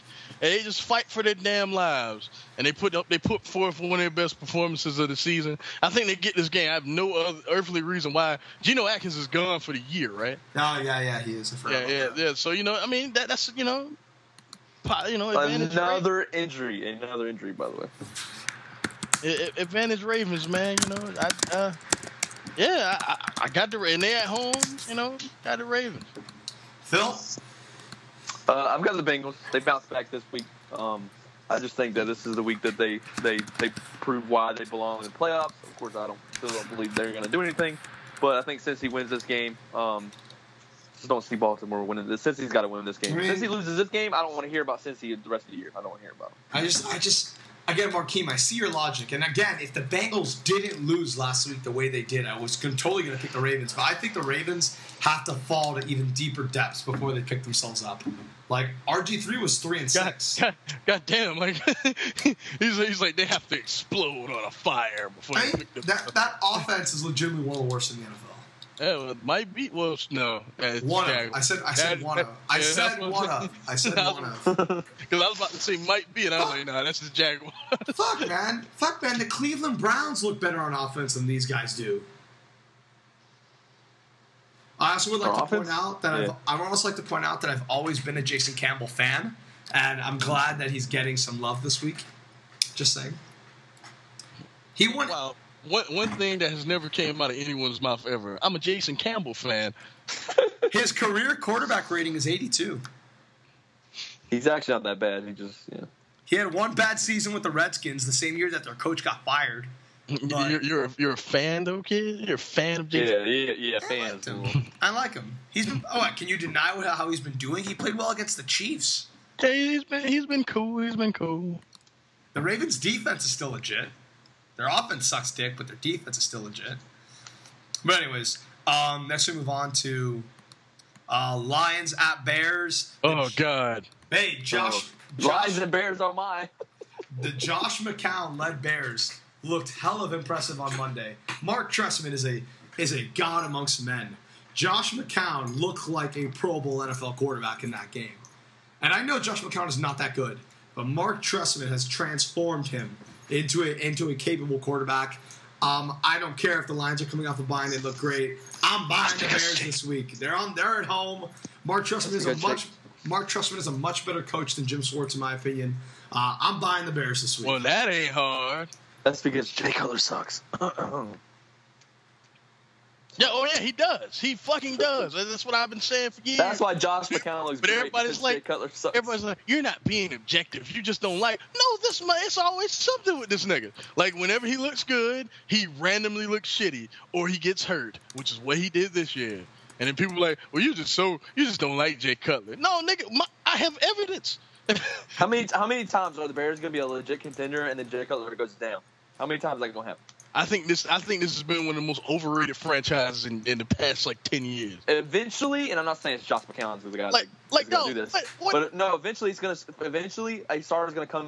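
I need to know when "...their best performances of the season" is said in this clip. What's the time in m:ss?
0:03.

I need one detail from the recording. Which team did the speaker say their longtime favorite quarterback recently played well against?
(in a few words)
Chiefs.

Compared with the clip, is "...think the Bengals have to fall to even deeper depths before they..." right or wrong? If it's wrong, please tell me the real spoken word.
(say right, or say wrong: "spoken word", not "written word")
wrong: "Ravens", not "Bengals".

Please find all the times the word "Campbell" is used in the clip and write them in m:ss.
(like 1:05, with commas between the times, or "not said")
1:28, 1:38.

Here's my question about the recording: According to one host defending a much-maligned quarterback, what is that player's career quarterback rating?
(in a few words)
82.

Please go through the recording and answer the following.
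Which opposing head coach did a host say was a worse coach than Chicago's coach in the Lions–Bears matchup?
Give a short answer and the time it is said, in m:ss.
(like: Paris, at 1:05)
Jim Schwartz, at 2:44.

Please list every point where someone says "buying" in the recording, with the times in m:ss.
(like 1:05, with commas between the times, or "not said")
2:38, 2:46.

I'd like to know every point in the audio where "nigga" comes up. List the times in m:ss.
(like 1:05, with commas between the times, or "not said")
3:03, 3:12.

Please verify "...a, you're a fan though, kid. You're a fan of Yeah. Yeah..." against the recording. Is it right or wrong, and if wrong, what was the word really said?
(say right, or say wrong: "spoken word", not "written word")
wrong: "Jason", not "Yeah".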